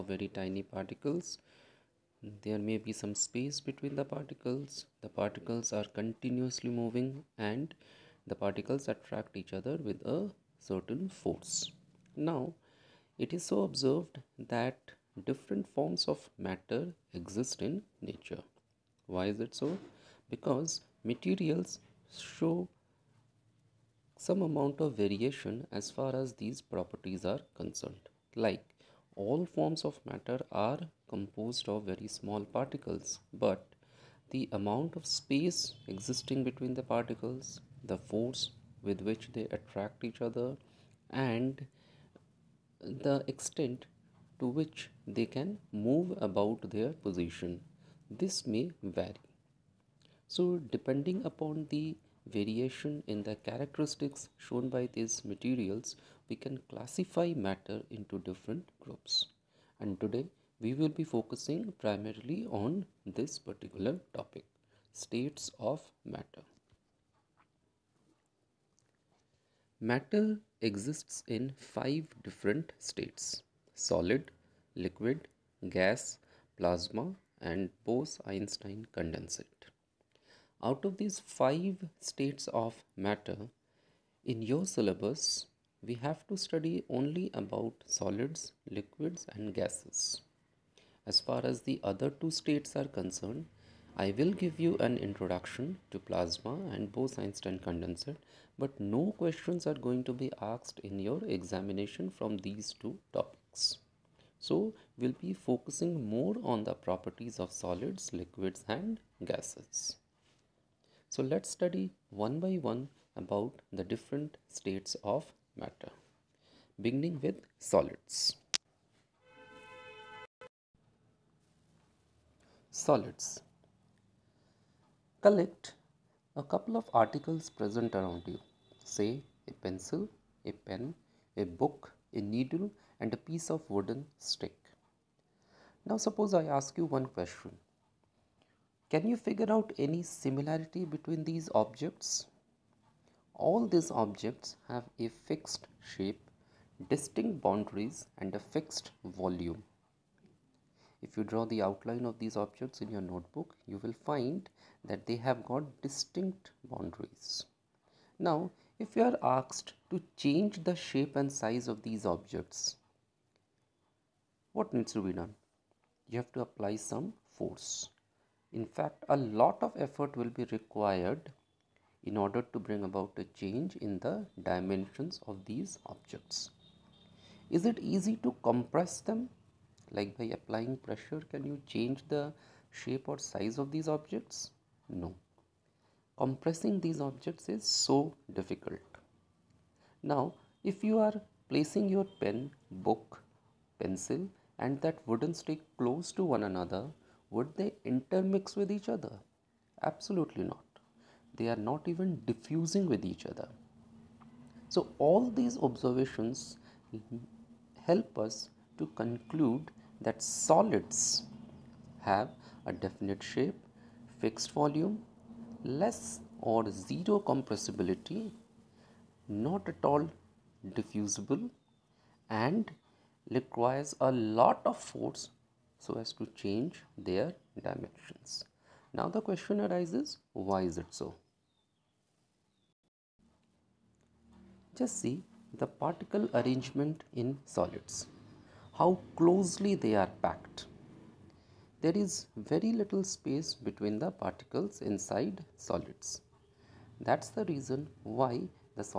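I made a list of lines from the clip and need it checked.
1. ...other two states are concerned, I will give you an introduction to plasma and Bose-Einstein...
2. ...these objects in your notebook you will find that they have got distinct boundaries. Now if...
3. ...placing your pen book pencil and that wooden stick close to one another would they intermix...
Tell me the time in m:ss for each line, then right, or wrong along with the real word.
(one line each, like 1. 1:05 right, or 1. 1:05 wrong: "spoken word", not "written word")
1. 1:31 right
2. 2:32 right
3. 3:11 right.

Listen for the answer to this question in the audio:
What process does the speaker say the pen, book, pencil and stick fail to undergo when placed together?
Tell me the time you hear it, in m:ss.
3:22.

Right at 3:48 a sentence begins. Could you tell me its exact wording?
Now the question arises, why is it so?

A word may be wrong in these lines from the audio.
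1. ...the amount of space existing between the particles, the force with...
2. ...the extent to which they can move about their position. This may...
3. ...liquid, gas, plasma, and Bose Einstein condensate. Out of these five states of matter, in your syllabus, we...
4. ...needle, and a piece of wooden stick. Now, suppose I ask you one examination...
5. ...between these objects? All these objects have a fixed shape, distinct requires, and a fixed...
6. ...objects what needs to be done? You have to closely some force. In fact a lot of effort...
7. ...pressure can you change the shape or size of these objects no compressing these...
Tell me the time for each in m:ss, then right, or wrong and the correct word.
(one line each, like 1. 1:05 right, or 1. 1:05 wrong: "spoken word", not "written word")
1. 0:34 right
2. 0:43 right
3. 1:14 right
4. 2:12 wrong: "question", not "examination"
5. 2:20 wrong: "boundaries", not "requires"
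6. 2:42 wrong: "apply", not "closely"
7. 3:00 right.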